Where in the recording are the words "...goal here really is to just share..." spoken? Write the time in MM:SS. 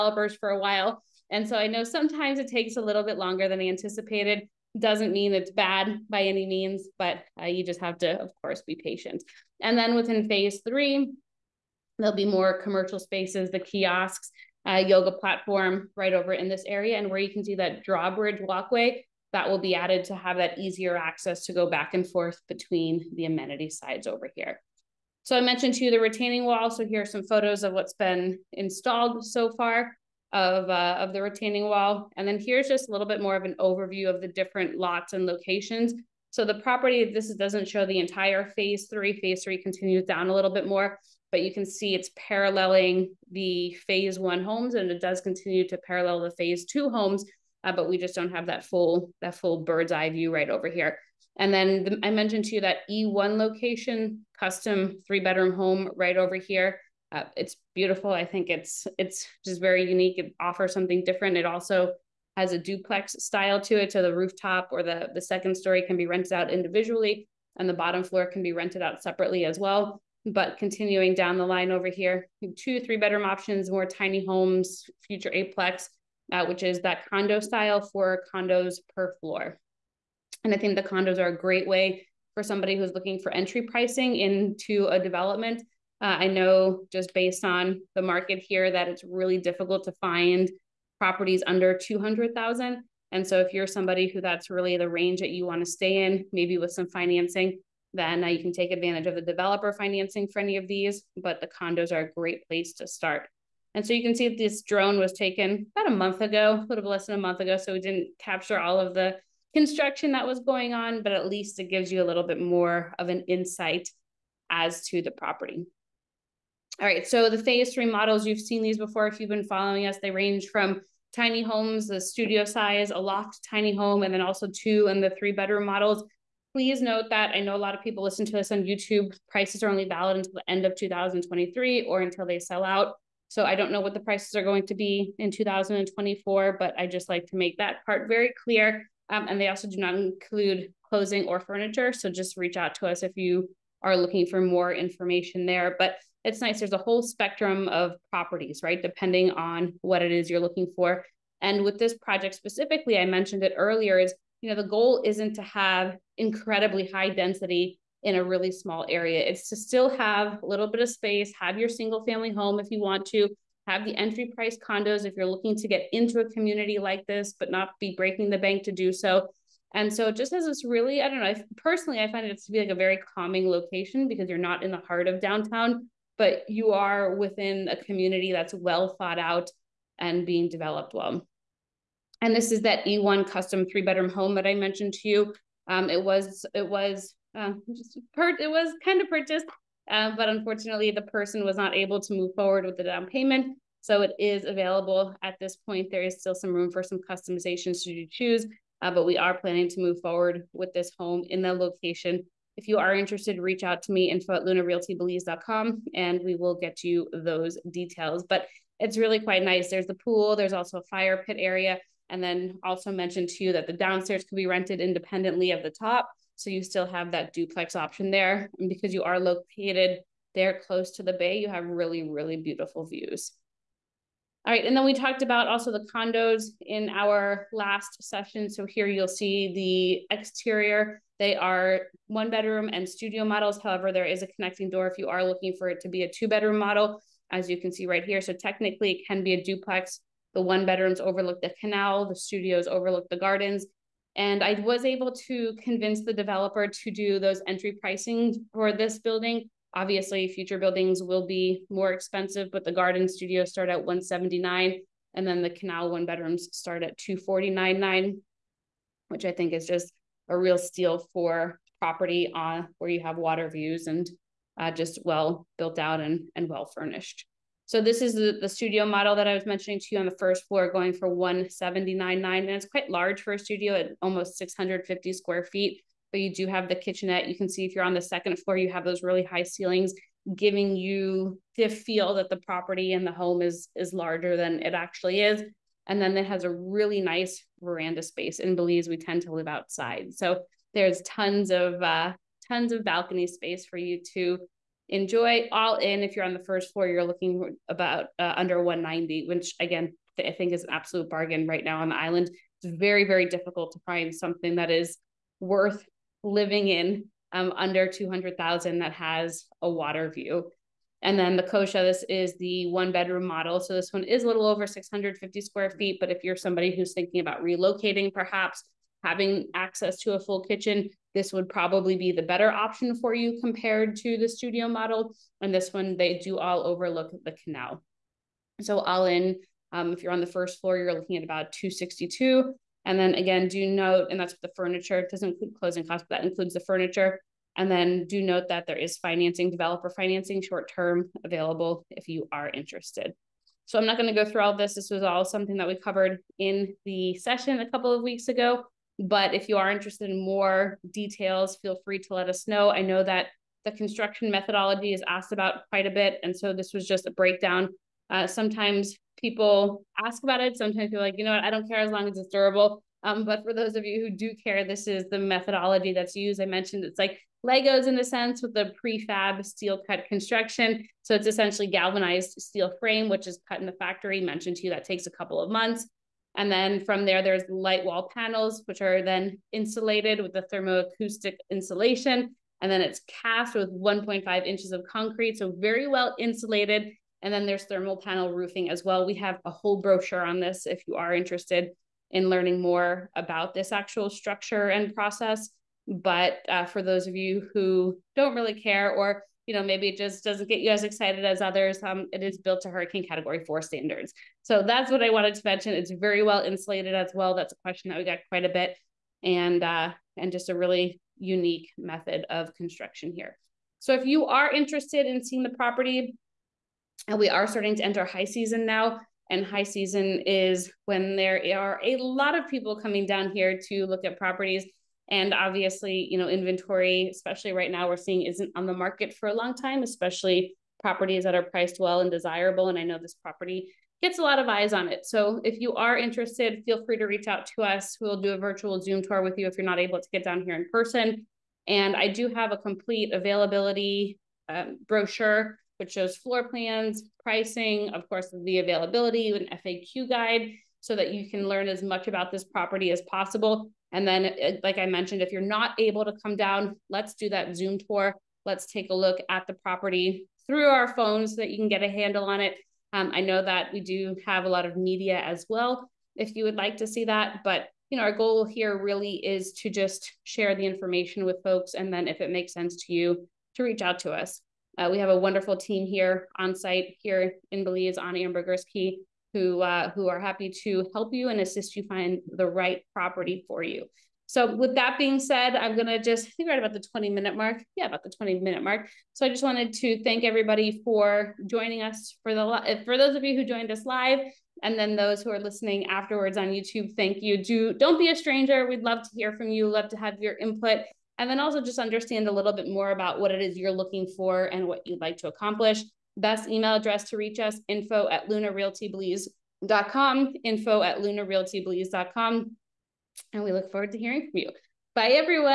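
07:48.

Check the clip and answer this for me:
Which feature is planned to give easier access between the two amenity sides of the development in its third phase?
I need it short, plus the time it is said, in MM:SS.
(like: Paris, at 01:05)
drawbridge walkway, at 00:17.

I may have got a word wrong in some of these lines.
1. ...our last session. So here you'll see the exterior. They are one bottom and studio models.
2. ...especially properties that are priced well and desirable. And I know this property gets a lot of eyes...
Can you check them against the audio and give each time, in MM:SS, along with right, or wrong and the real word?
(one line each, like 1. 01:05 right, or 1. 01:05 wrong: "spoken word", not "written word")
1. 03:46 wrong: "bedroom", not "bottom"
2. 07:09 right.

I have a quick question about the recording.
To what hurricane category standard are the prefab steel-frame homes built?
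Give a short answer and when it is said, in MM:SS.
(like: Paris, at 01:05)
category four, at 06:43.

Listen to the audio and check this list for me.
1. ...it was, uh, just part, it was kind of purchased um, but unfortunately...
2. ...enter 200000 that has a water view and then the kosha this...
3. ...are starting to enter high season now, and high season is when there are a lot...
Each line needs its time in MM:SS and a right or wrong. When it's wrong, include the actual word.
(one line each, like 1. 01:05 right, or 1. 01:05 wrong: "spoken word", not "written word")
1. 03:06 right
2. 05:07 wrong: "under", not "enter"
3. 06:57 right.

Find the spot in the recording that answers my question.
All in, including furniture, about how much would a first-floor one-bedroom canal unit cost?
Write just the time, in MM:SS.
05:31.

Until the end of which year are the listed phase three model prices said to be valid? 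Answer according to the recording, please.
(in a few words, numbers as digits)
2023.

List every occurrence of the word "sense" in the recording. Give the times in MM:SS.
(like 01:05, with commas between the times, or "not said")
06:08, 07:52.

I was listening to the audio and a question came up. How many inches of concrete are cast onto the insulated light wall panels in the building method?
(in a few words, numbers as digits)
1.5 inches.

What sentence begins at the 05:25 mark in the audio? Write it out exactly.
And this one, they do all overlook the canal.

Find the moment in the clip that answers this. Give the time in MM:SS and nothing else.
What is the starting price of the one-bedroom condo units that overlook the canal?
04:16.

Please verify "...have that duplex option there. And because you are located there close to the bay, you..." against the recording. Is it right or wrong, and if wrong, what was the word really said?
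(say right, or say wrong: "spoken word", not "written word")
right.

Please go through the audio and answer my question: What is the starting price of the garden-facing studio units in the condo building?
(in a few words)
179.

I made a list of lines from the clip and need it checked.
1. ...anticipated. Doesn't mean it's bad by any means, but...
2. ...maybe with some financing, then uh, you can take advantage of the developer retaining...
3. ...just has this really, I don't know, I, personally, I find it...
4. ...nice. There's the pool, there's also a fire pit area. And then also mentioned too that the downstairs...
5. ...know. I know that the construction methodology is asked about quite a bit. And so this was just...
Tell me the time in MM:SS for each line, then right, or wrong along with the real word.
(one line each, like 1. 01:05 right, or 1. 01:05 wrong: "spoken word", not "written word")
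1. 00:03 right
2. 01:36 wrong: "financing", not "retaining"
3. 02:50 right
4. 03:29 right
5. 05:52 right.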